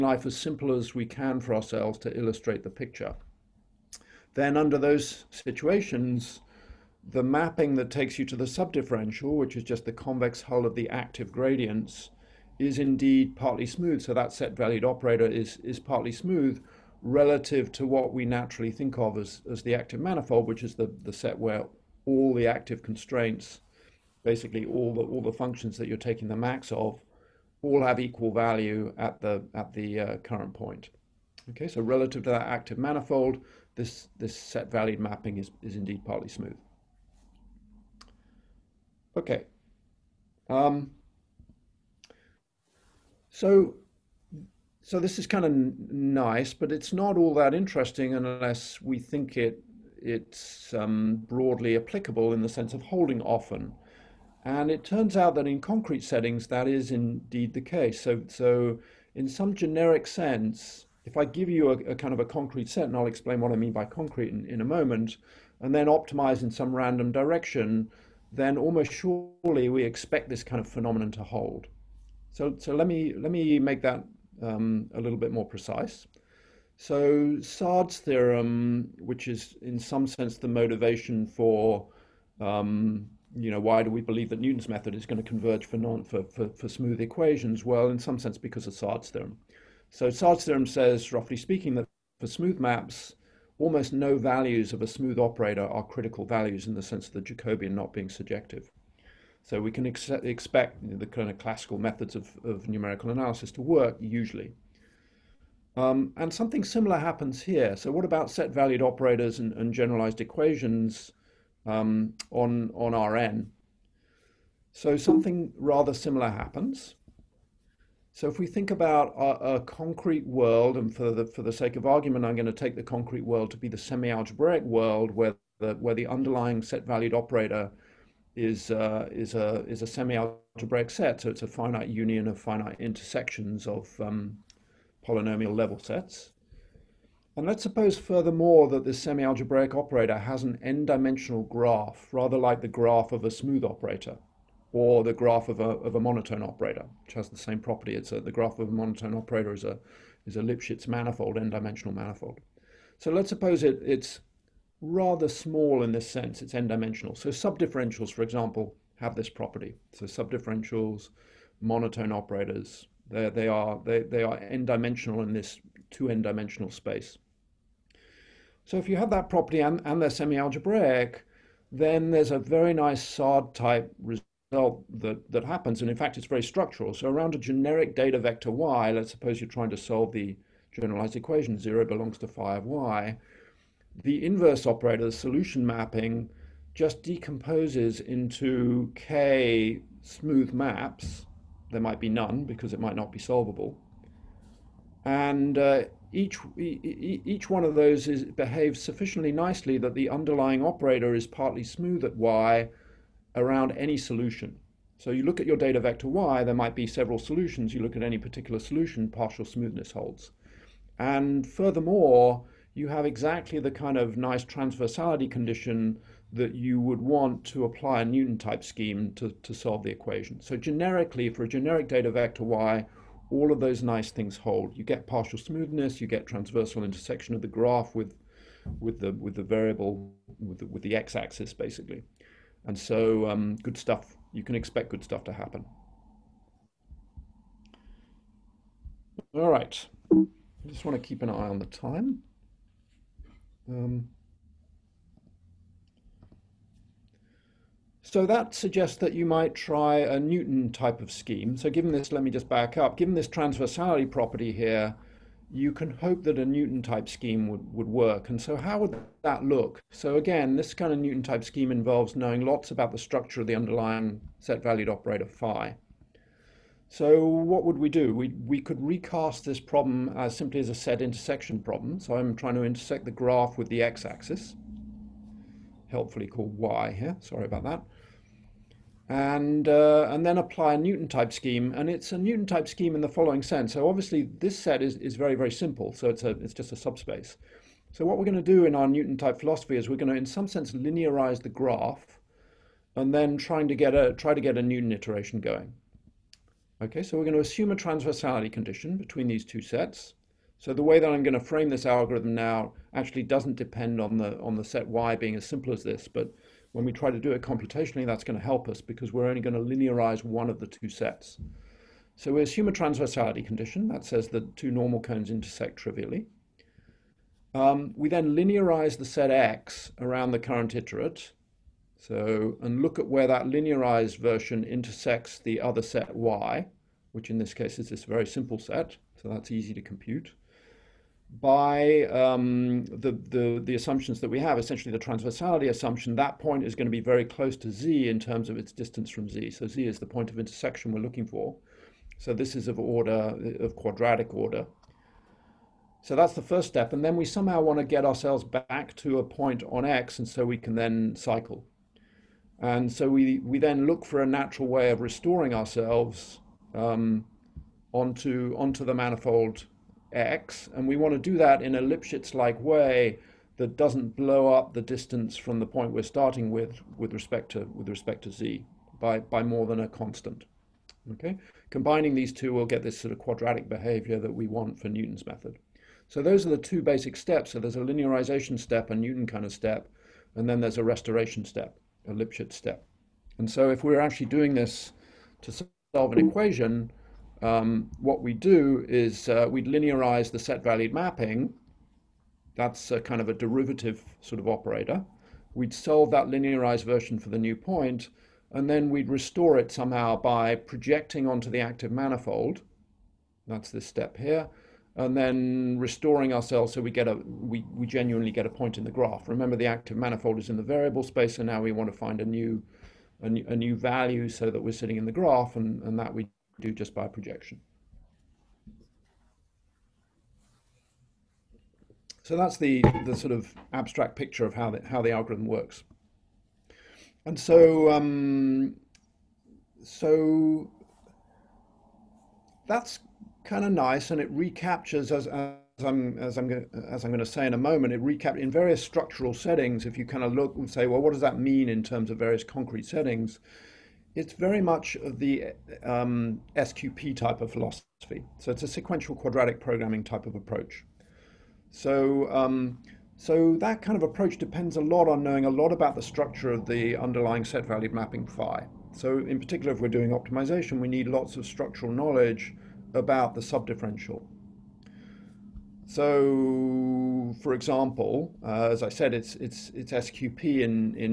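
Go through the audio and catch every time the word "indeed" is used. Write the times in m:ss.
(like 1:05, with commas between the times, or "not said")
0:12, 0:35, 0:56.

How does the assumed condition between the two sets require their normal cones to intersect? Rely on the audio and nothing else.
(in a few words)
trivially.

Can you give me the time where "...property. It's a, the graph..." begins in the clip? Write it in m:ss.
2:27.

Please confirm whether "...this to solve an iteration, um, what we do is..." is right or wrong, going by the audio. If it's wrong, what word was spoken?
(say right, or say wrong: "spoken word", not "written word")
wrong: "equation", not "iteration".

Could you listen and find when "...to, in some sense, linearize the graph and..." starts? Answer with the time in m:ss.
4:50.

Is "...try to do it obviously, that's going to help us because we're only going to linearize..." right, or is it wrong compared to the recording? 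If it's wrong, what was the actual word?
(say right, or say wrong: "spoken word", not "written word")
wrong: "computationally", not "obviously".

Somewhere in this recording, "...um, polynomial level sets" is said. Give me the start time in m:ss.
2:14.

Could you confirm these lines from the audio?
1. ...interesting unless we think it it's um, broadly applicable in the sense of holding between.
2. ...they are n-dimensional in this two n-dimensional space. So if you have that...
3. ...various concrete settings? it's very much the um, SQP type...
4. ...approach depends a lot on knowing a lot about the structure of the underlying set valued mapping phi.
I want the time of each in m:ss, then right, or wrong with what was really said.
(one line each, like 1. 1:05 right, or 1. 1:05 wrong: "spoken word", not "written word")
1. 0:47 wrong: "often", not "between"
2. 2:44 right
3. 7:22 right
4. 7:34 right.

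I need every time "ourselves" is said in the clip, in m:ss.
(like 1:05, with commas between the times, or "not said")
0:01, 5:48, 5:55, 6:46.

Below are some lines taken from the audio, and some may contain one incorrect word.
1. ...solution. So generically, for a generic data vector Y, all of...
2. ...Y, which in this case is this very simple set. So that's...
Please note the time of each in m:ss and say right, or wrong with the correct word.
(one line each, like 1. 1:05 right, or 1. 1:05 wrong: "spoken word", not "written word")
1. 3:39 wrong: "equation", not "solution"
2. 5:26 right.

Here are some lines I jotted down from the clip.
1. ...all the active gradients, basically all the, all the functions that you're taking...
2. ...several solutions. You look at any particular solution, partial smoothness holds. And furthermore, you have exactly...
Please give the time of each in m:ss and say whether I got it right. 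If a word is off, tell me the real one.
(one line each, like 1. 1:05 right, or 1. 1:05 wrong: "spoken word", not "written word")
1. 0:22 wrong: "constraints", not "gradients"
2. 3:26 right.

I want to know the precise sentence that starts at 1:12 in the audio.
So, so let me let me make that um, a little bit more precise.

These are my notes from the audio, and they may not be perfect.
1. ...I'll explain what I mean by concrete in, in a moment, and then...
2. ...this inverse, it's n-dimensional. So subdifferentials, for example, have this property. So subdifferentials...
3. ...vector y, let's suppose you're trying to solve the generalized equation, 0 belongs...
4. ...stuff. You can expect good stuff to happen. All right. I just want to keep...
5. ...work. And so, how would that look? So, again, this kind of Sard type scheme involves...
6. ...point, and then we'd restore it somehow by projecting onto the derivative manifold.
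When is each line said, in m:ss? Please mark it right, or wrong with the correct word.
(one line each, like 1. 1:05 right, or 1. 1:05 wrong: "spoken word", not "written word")
1. 1:02 right
2. 2:35 wrong: "sense", not "inverse"
3. 2:58 right
4. 3:53 right
5. 4:17 wrong: "Newton", not "Sard"
6. 6:37 wrong: "active", not "derivative".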